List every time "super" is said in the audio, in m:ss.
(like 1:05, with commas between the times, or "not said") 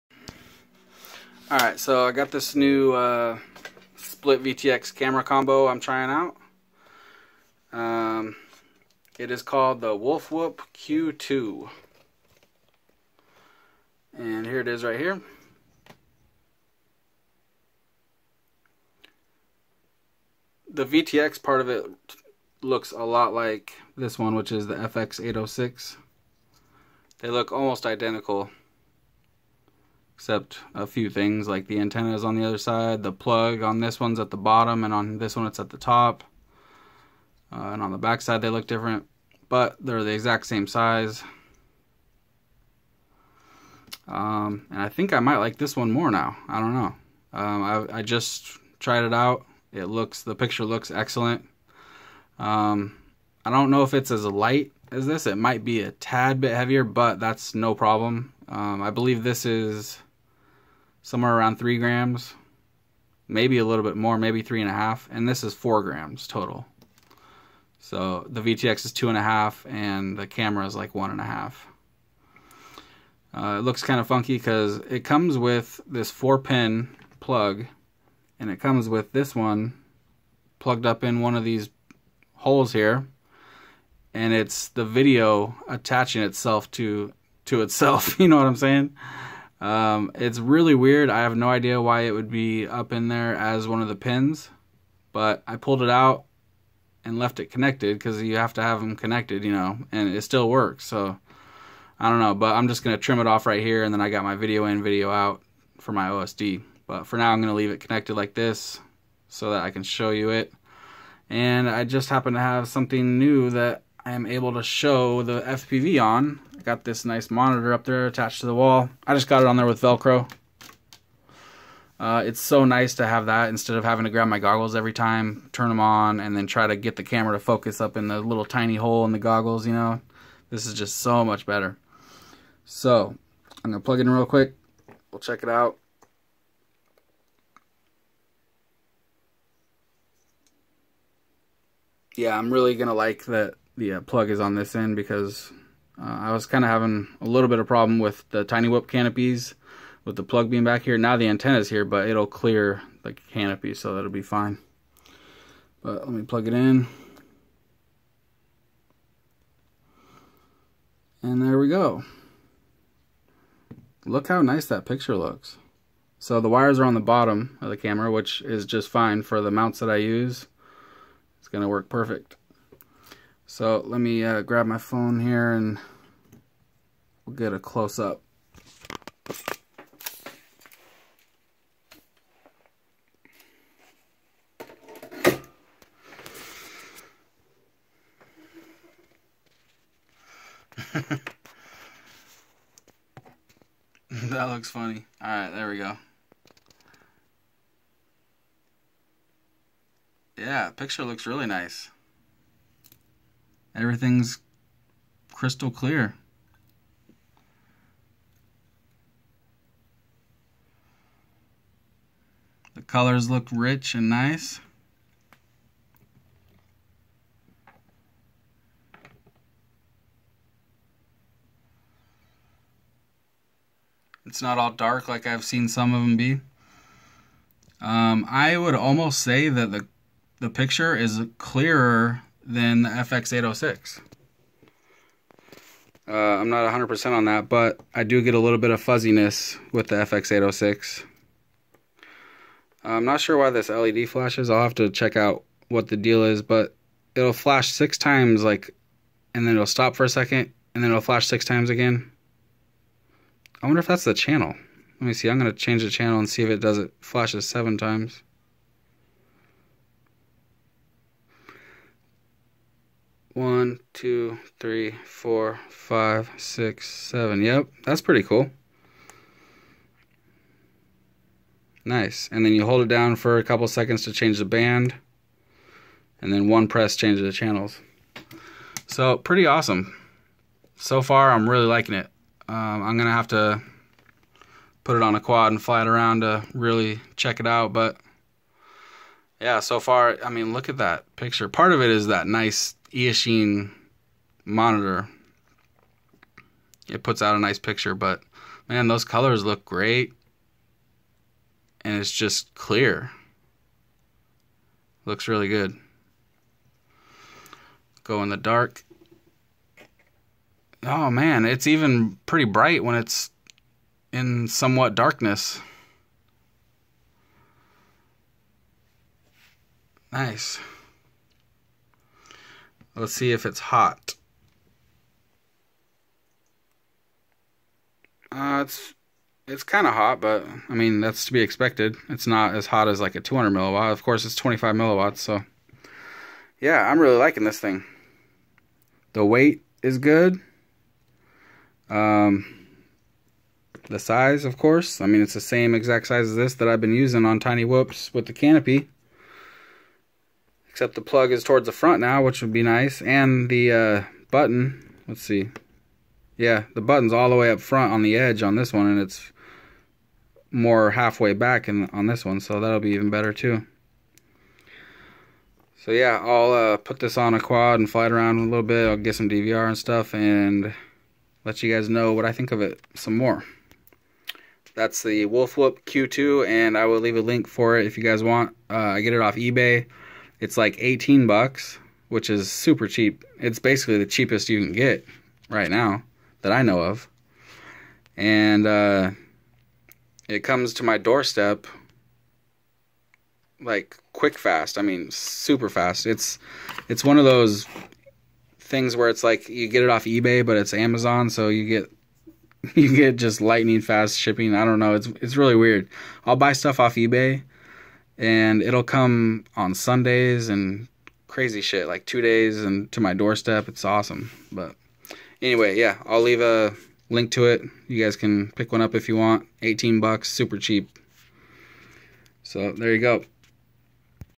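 6:22, 6:35, 7:00.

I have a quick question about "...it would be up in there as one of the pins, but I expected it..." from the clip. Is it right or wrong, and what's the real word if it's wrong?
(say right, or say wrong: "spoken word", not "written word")
wrong: "pulled", not "expected".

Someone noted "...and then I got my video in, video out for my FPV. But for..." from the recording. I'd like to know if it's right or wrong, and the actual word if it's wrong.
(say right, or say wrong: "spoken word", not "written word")
wrong: "OSD", not "FPV".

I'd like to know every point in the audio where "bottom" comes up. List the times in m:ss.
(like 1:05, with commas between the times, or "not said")
0:34, 2:46.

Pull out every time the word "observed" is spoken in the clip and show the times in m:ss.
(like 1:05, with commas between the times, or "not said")
not said.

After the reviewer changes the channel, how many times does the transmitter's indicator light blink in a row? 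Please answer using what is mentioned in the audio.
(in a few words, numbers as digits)
7.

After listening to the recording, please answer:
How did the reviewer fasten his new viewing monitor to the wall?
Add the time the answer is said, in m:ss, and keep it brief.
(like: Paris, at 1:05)
Velcro, at 1:59.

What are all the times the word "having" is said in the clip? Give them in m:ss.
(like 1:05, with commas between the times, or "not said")
2:03, 2:26.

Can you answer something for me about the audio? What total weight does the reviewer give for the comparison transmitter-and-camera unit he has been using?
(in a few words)
4 grams.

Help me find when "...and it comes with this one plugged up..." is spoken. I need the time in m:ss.
1:18.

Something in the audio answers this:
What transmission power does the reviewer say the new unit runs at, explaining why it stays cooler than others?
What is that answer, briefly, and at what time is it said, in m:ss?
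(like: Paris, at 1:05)
25 milliwatts, at 5:34.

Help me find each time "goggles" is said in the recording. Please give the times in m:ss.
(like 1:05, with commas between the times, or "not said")
2:04, 2:09.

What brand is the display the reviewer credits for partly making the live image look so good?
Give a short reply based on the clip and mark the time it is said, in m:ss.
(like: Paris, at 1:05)
Eachine, at 4:52.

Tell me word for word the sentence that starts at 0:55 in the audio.
It might be a tad bit heavier, but that's no problem.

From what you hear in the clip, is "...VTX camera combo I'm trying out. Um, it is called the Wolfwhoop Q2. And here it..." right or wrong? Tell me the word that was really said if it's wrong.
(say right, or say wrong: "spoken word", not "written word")
right.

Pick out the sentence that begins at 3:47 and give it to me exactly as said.
Um, I would almost say that the the picture is clearer than the FX806.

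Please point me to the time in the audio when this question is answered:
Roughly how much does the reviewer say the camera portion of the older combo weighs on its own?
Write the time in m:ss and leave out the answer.
1:10.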